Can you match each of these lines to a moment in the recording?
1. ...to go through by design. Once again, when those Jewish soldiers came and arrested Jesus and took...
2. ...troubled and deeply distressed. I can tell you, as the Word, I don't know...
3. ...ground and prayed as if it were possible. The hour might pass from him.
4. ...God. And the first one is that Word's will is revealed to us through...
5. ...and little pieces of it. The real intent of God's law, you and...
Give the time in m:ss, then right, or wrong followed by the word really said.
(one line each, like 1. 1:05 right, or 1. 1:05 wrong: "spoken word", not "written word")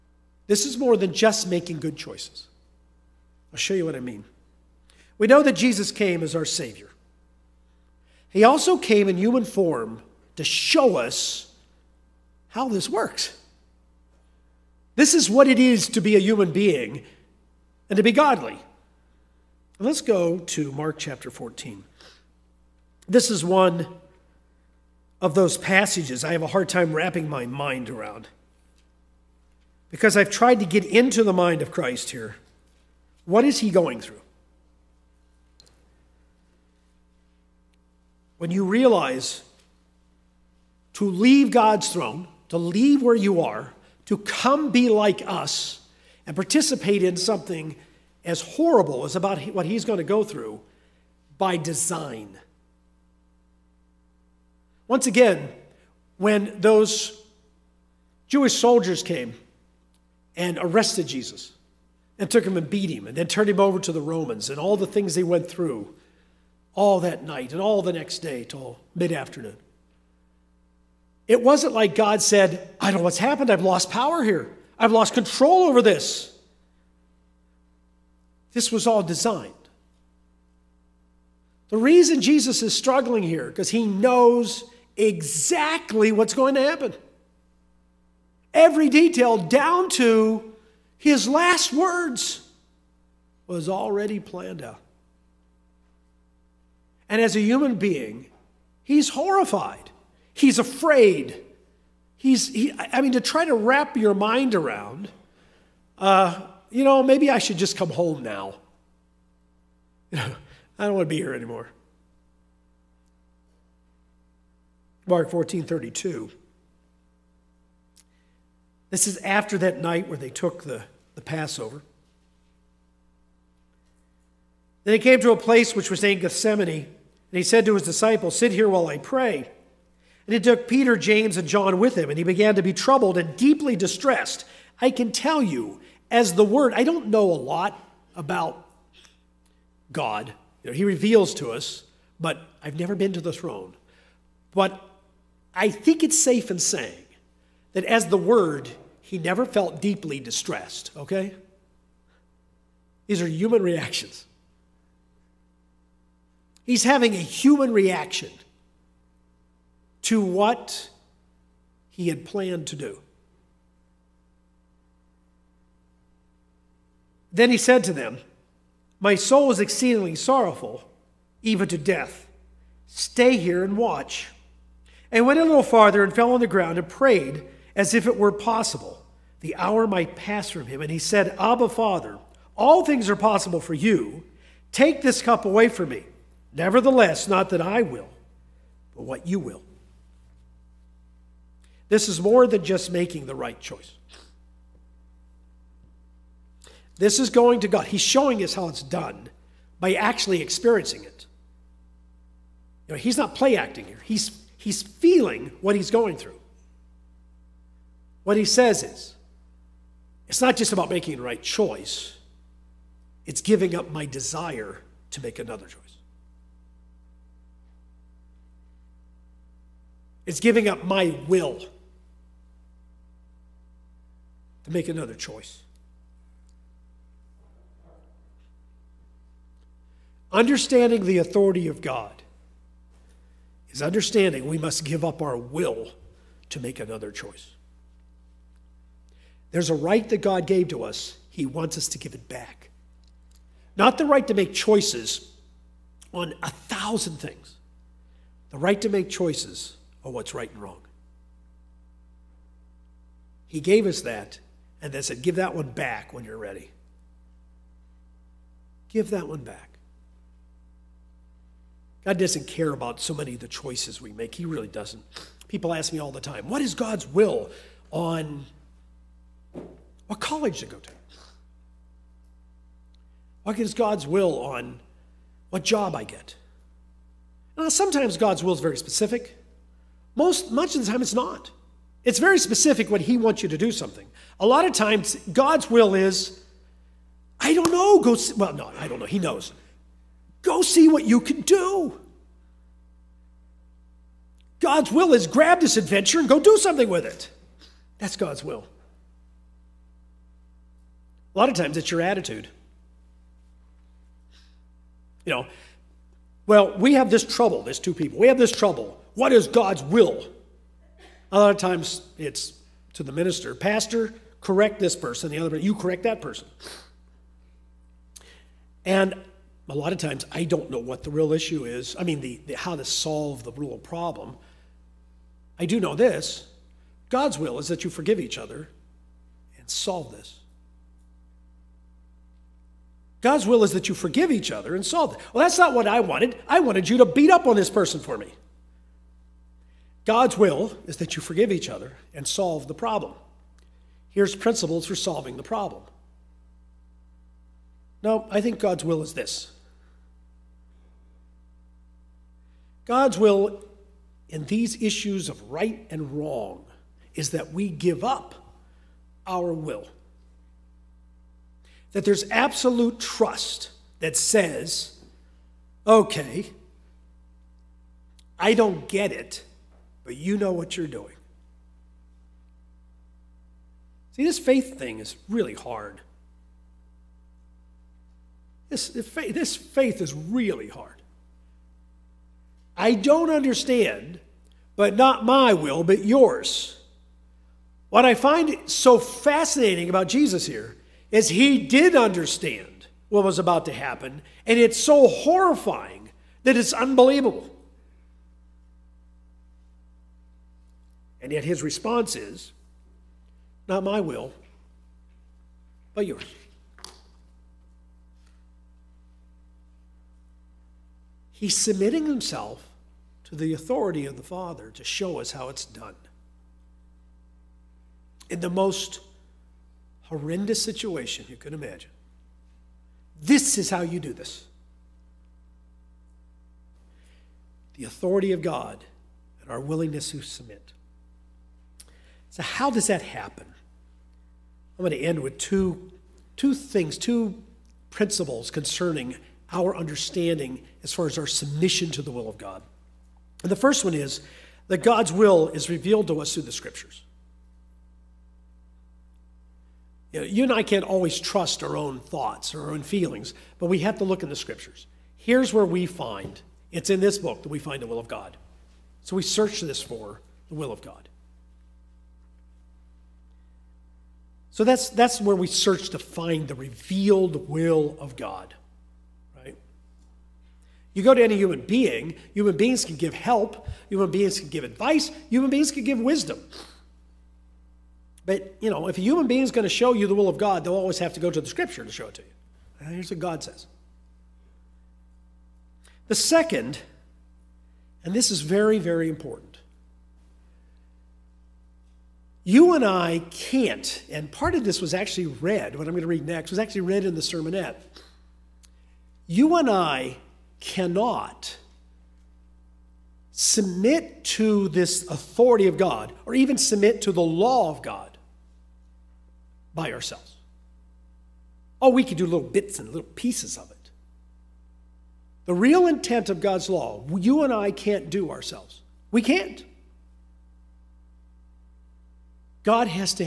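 1. 0:49 right
2. 2:12 right
3. 2:56 right
4. 7:22 wrong: "God", not "Word"
5. 8:32 right.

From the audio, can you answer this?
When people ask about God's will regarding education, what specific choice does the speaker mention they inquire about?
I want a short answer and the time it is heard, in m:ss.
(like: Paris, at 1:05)
What college to go to, at 4:30.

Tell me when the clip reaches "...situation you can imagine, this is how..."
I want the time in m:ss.
7:00.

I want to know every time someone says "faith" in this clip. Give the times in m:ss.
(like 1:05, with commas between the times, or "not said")
6:14, 6:19.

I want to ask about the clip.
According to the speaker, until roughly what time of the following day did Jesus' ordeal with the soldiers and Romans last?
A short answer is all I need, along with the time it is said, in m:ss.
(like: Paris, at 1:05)
Mid afternoon, at 1:08.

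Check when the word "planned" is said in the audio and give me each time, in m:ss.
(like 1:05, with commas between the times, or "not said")
1:34, 2:42.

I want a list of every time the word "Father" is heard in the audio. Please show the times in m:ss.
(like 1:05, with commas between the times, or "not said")
3:01, 6:54.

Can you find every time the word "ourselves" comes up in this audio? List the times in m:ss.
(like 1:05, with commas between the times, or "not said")
8:29, 8:38.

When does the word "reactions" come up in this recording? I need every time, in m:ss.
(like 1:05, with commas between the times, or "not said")
2:33, 2:37.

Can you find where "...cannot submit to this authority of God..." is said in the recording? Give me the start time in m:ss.
8:20.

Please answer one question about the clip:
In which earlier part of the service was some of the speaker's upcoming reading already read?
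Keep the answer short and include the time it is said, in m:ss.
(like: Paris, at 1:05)
The sermonette, at 8:17.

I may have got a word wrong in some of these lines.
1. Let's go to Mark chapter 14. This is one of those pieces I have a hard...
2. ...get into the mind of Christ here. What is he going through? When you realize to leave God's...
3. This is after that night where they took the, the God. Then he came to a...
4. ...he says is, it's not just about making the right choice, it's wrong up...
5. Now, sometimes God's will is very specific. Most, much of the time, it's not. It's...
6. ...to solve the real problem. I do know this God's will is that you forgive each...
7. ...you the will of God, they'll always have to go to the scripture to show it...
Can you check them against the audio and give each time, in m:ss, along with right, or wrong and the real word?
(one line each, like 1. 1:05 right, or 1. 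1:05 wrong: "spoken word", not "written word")
1. 0:19 wrong: "passages", not "pieces"
2. 0:30 right
3. 1:58 wrong: "Passover", not "God"
4. 3:28 wrong: "giving", not "wrong"
5. 4:37 right
6. 5:22 right
7. 7:59 right.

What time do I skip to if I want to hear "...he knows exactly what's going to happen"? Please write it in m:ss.
1:23.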